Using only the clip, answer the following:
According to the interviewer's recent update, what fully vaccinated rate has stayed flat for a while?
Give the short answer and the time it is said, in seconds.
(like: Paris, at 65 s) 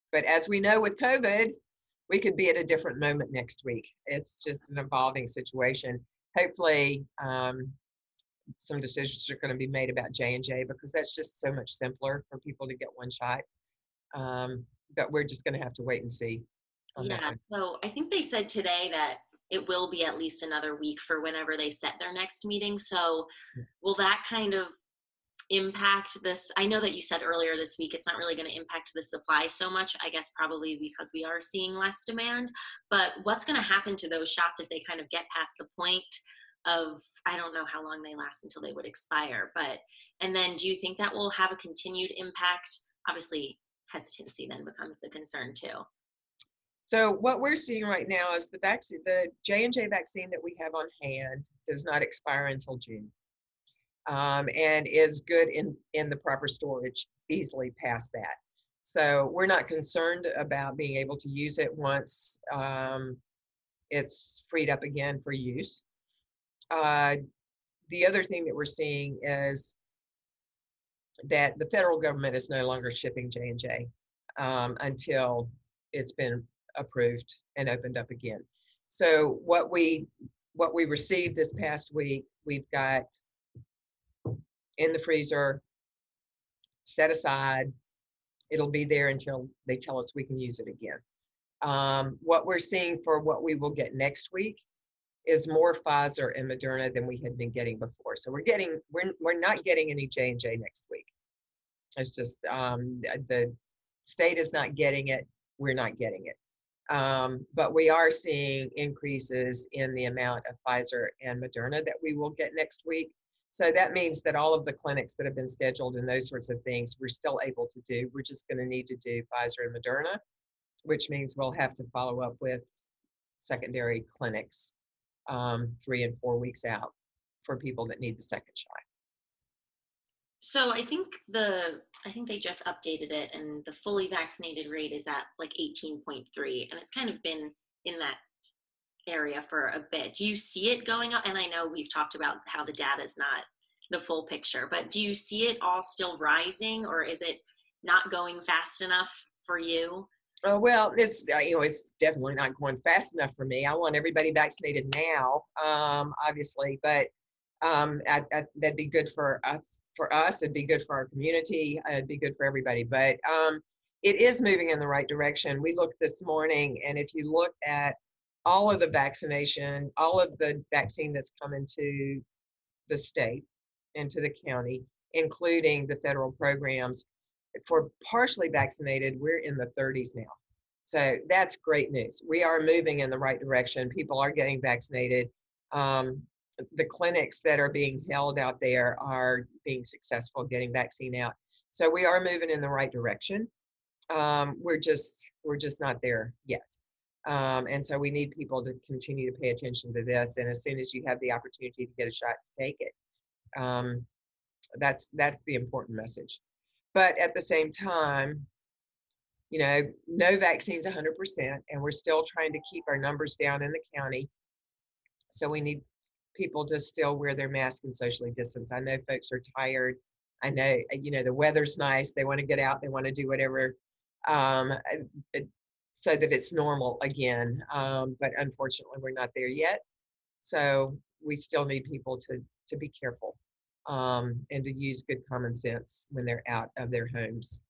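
18.3, at 135 s.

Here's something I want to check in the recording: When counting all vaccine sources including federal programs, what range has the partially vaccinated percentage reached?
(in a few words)
the 30s.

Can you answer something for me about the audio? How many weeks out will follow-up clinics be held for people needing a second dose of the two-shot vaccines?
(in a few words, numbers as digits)
3 and 4 weeks.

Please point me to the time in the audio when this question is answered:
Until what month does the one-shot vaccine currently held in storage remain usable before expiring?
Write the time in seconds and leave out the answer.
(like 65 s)
52 s.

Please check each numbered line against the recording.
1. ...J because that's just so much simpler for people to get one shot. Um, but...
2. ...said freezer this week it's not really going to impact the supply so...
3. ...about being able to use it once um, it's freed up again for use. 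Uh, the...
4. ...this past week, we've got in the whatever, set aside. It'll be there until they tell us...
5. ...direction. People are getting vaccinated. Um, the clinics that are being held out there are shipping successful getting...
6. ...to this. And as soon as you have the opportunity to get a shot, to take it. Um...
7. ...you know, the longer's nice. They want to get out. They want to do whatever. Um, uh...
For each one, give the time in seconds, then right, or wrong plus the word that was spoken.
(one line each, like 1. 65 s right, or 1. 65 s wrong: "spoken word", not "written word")
1. 10 s right
2. 27 s wrong: "earlier", not "freezer"
3. 60 s right
4. 81 s wrong: "freezer", not "whatever"
5. 183 s wrong: "being", not "shipping"
6. 199 s right
7. 220 s wrong: "weather", not "longer".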